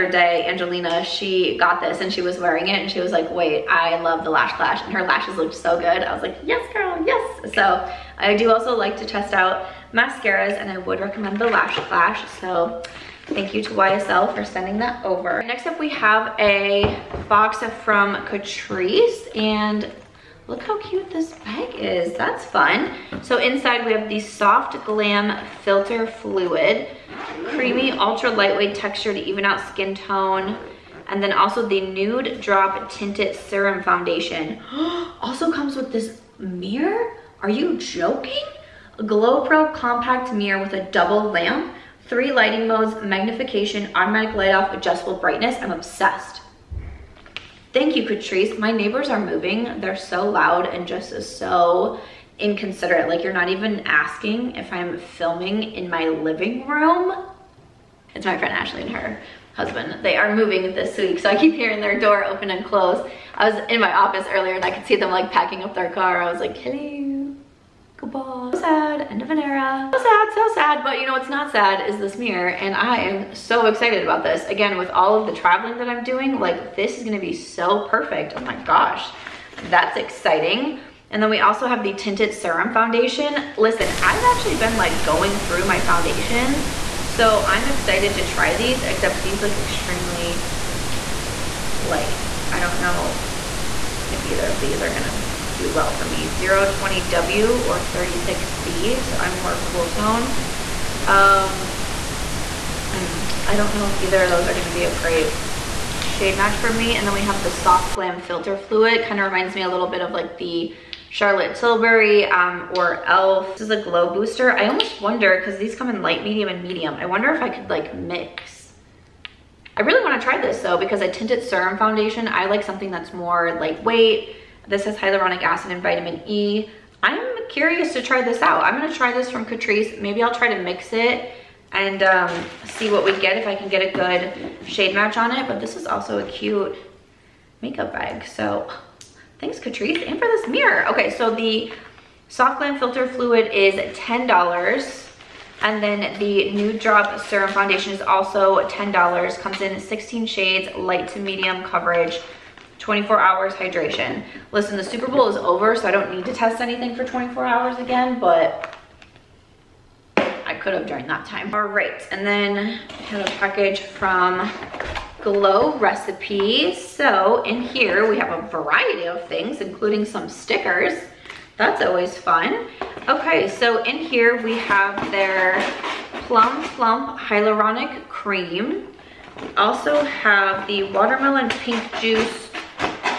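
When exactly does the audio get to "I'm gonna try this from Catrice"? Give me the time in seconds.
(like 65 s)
128 s.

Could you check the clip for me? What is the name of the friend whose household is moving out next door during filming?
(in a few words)
Ashley.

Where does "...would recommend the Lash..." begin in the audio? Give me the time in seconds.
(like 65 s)
10 s.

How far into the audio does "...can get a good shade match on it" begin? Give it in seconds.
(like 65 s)
133 s.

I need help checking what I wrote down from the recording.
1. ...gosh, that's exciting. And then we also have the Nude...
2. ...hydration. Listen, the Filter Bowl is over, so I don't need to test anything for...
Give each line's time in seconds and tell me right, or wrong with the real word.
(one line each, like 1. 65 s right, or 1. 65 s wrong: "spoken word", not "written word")
1. 78 s wrong: "Tinted", not "Nude"
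2. 153 s wrong: "Super", not "Filter".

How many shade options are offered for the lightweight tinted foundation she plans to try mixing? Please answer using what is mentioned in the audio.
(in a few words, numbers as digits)
16.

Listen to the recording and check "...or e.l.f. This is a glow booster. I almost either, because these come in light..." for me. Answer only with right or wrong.
wrong.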